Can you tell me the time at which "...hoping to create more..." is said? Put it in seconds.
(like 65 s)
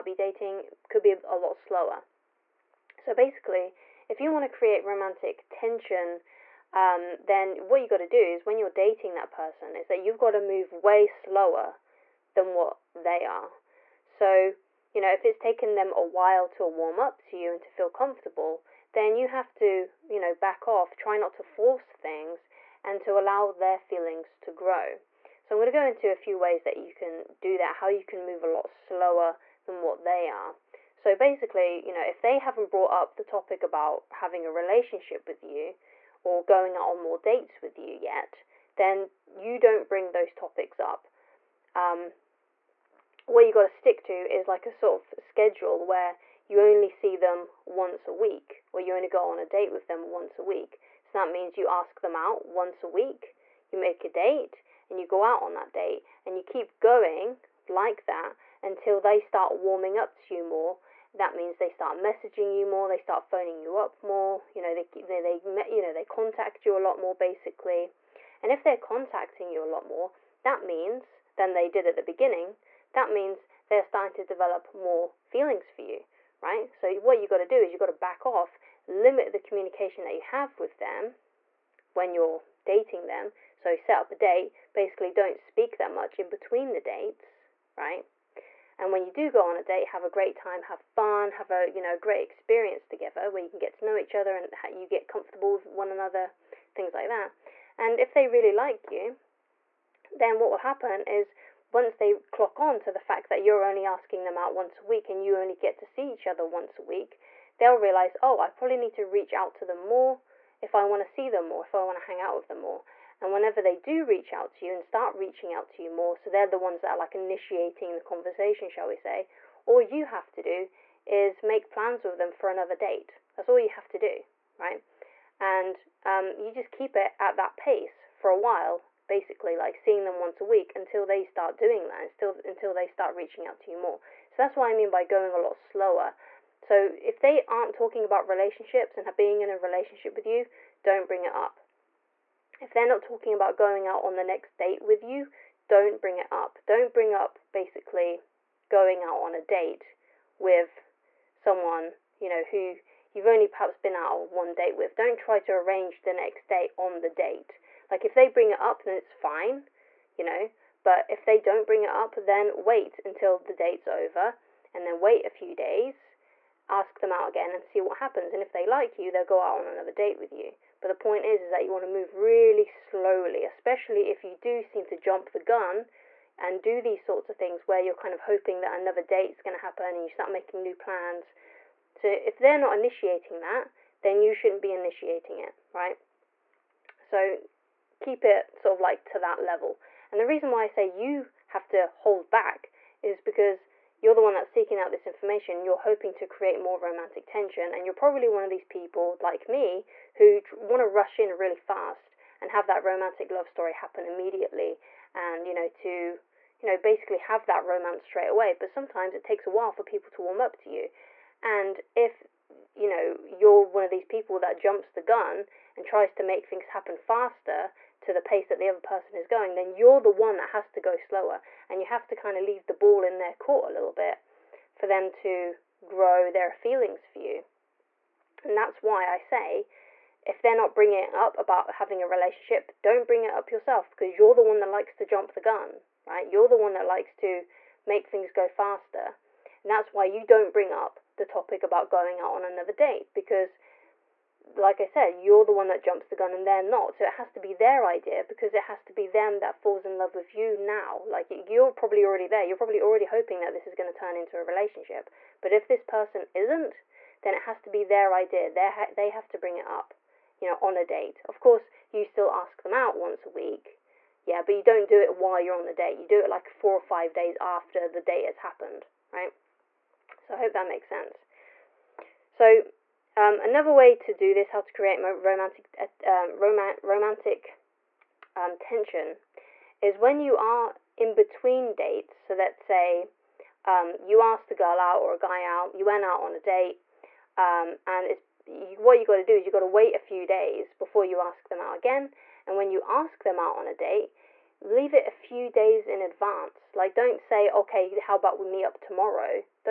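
195 s.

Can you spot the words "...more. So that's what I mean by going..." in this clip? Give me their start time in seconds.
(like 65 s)
133 s.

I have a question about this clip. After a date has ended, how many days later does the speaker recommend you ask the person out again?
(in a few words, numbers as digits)
4 or 5 days.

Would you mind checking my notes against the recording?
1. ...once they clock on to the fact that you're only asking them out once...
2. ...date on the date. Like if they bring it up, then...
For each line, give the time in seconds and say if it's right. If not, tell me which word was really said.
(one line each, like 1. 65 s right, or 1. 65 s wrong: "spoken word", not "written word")
1. 101 s right
2. 156 s right.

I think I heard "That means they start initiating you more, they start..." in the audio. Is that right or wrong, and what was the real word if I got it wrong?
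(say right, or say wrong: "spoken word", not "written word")
wrong: "messaging", not "initiating".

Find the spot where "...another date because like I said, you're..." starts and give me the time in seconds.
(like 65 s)
242 s.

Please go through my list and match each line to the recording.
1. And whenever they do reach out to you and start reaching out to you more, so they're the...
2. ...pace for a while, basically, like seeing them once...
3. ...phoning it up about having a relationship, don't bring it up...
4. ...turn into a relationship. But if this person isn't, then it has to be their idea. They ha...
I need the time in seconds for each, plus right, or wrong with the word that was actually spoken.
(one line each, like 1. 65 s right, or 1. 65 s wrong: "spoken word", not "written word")
1. 113 s right
2. 127 s right
3. 230 s wrong: "bringing", not "phoning"
4. 253 s right.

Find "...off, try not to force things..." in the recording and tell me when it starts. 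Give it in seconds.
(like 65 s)
20 s.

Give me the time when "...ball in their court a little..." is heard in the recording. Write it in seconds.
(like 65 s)
222 s.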